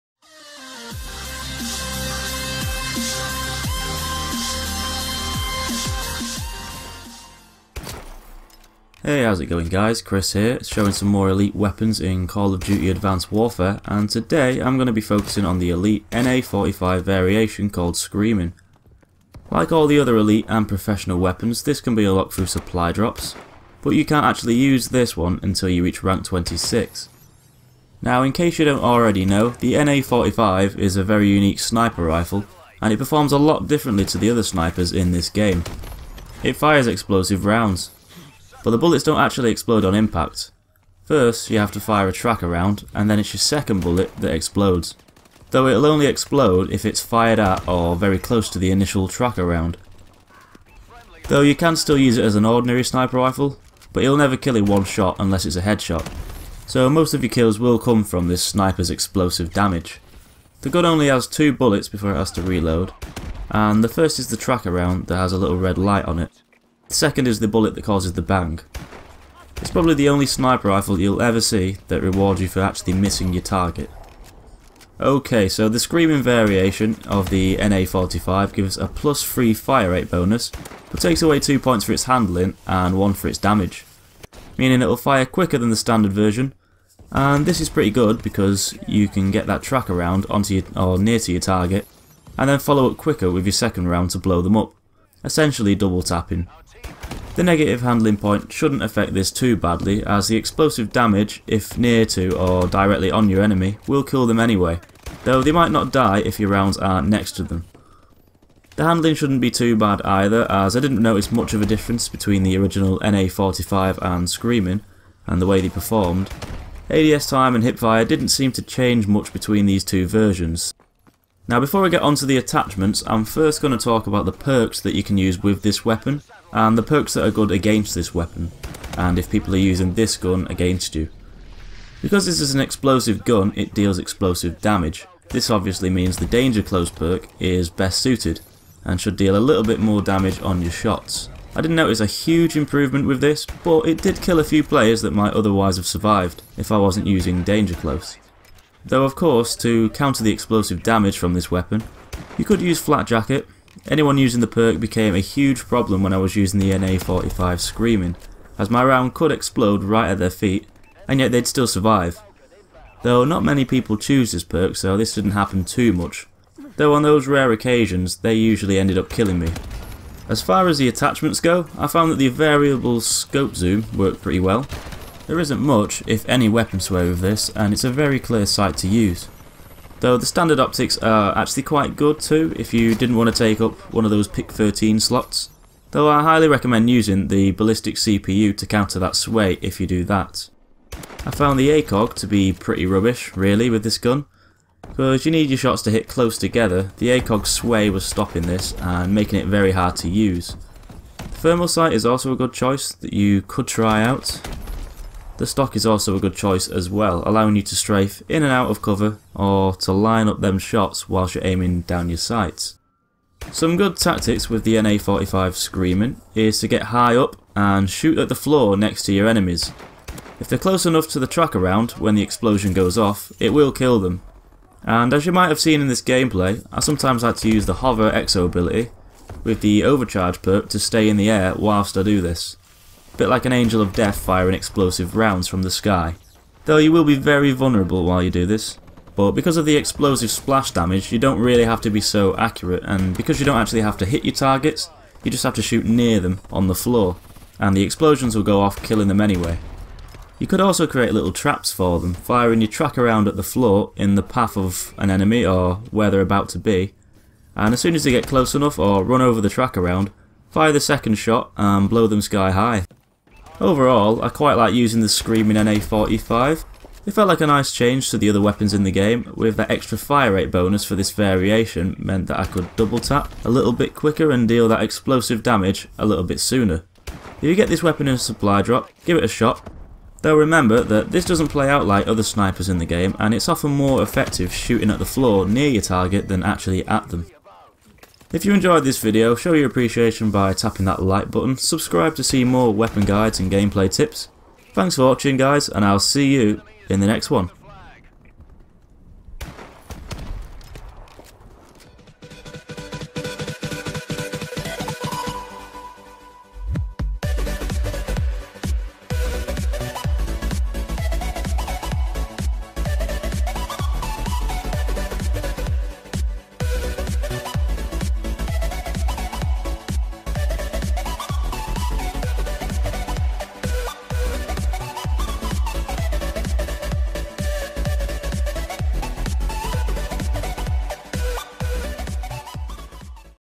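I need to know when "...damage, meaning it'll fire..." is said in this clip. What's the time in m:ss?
1:23.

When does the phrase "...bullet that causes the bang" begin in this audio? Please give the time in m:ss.
1:07.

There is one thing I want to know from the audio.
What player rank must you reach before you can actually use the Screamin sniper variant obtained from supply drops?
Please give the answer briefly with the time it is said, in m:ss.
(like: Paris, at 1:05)
26, at 0:26.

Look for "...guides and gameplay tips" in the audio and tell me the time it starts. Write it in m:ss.
4:53.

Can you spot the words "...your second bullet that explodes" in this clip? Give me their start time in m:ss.
0:43.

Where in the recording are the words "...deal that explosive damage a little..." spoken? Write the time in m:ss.
4:34.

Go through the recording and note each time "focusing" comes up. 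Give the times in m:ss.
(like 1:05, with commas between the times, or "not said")
0:15.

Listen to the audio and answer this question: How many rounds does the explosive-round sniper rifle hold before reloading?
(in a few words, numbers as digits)
2.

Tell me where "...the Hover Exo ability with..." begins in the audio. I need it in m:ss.
3:47.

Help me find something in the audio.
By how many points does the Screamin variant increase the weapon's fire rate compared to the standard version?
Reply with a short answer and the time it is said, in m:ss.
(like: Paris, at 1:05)
3, at 1:18.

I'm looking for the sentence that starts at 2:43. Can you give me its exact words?
Though not many people choose this perk, so this didn't happen too much.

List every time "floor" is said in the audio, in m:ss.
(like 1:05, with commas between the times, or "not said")
3:38, 4:06, 4:13, 4:45.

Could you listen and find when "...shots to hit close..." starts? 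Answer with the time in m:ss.
3:15.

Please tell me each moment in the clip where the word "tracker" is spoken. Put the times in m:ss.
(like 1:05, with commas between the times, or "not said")
0:42, 0:49, 1:04, 1:29, 3:41, 4:12, 4:19.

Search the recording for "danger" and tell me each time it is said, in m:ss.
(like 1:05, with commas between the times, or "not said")
2:16, 2:27.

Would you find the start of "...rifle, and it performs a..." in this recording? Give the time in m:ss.
0:32.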